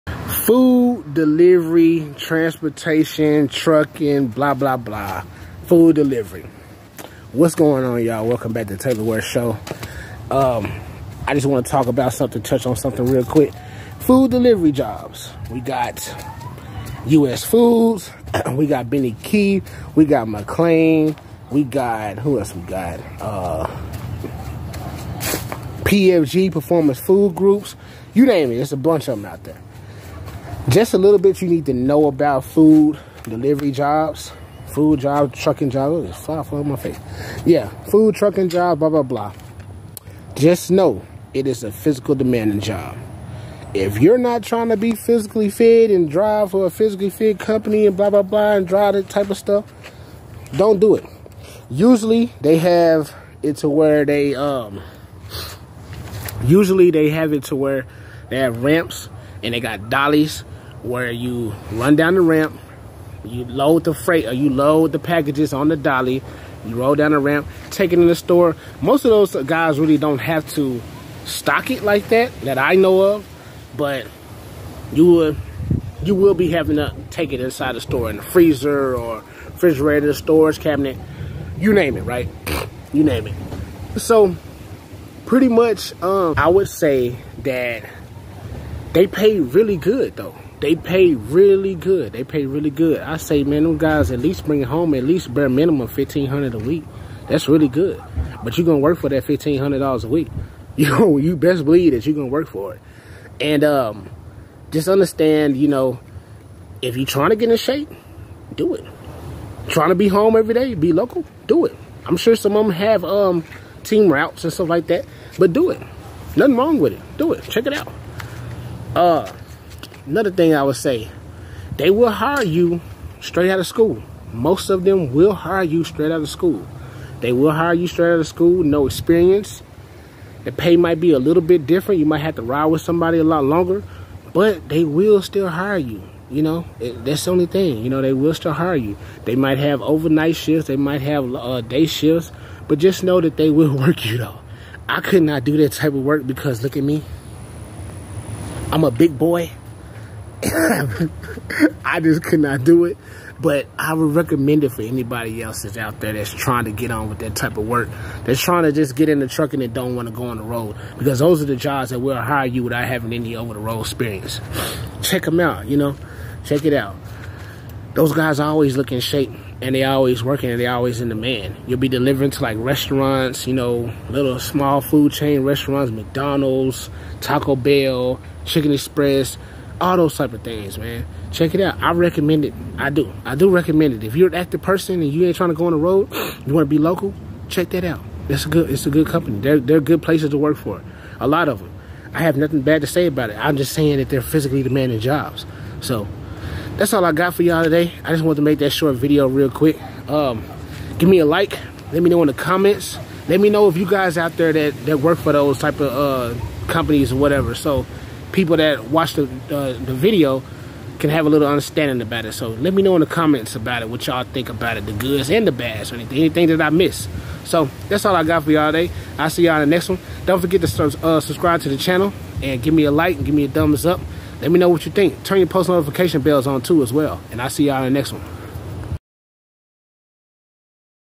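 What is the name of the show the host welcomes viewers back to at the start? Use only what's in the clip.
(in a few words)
Taylor Ware Show.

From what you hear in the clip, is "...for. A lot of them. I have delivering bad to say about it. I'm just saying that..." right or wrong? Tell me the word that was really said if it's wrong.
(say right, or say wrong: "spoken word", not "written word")
wrong: "nothing", not "delivering".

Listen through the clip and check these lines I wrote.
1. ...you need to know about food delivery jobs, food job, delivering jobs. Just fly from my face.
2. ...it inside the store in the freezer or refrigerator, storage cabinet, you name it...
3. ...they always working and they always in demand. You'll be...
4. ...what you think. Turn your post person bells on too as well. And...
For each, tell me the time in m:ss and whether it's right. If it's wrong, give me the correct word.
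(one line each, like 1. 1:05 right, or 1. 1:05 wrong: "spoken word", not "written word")
1. 0:31 wrong: "trucking", not "delivering"
2. 1:17 right
3. 2:49 right
4. 3:44 wrong: "notification", not "person".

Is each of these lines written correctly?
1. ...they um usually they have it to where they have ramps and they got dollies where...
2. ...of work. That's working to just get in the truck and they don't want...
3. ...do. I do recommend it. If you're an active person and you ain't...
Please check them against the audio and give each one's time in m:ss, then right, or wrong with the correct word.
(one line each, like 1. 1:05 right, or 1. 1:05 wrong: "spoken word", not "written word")
1. 0:54 right
2. 2:37 wrong: "trying", not "working"
3. 3:02 right.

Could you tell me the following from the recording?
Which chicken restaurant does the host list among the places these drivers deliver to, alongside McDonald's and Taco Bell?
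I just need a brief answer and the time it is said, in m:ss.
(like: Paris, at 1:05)
Chicken Express, at 2:58.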